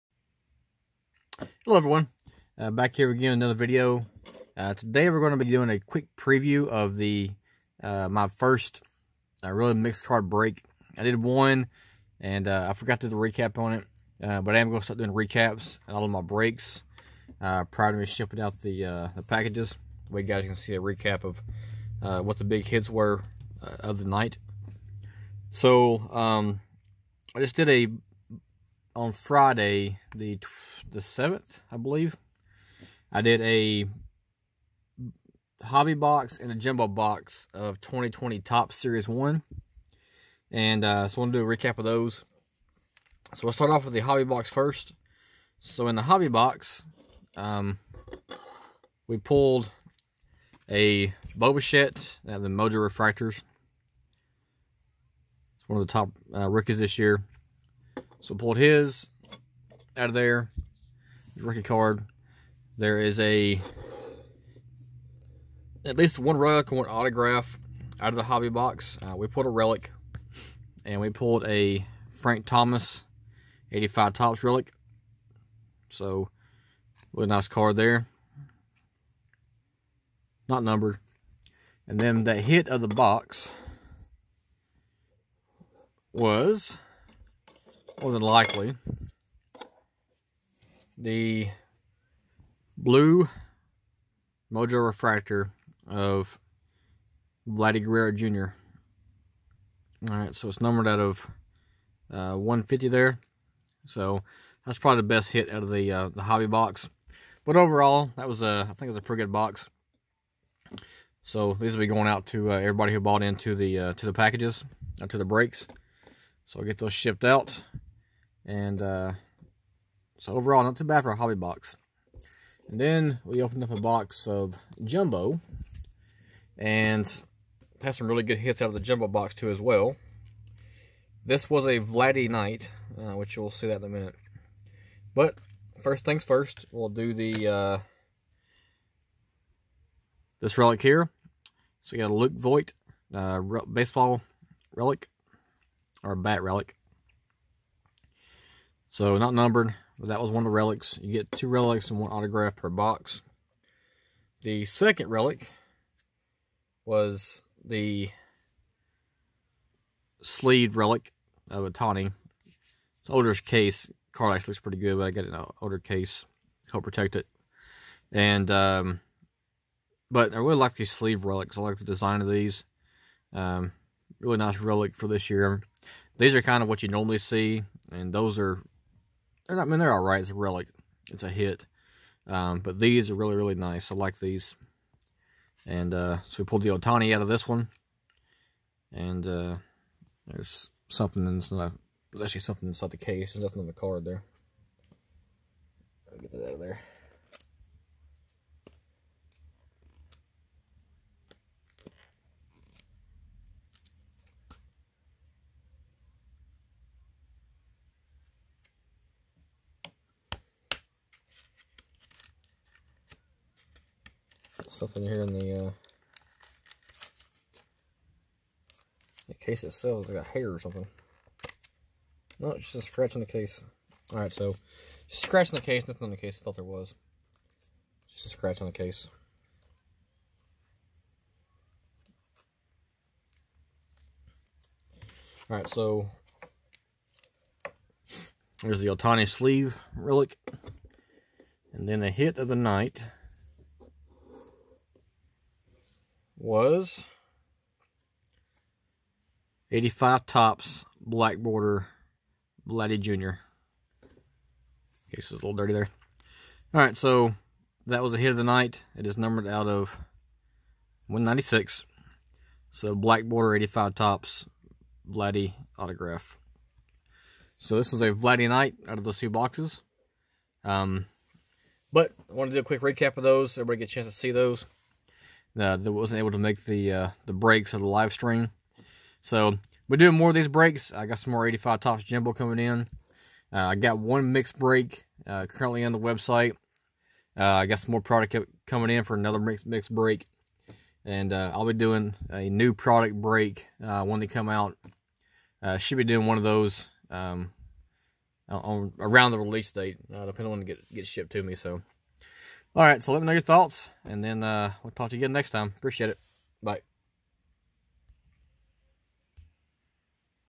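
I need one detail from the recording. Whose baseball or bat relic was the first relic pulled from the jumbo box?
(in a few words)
Luke Voit.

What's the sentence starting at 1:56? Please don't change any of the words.
So I'll get those shipped out.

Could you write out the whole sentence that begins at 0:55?
It's one of the top uh, rookies this year.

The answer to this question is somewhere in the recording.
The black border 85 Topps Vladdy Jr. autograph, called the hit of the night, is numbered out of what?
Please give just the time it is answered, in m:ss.
4:21.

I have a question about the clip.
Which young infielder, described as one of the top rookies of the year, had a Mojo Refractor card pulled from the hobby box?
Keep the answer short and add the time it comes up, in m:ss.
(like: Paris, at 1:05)
Bo Bichette, at 0:51.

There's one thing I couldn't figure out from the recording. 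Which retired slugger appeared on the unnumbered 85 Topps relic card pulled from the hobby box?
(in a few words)
Frank Thomas.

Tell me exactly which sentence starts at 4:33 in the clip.
Everybody get a chance to see those uh, that wasn't able to make the uh, the breaks of the live stream.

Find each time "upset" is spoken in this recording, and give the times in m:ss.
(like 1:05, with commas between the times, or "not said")
not said.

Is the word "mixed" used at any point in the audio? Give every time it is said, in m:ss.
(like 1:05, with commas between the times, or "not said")
0:09, 4:44, 4:49.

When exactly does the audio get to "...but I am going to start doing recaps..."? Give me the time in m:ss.
0:14.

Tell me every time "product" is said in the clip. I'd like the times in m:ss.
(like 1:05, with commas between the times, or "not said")
4:48, 4:52.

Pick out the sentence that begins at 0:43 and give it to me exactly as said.
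So we'll start off with the hobby box first.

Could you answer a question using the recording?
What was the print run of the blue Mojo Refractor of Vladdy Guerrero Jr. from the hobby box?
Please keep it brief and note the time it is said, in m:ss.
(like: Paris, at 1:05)
150, at 1:42.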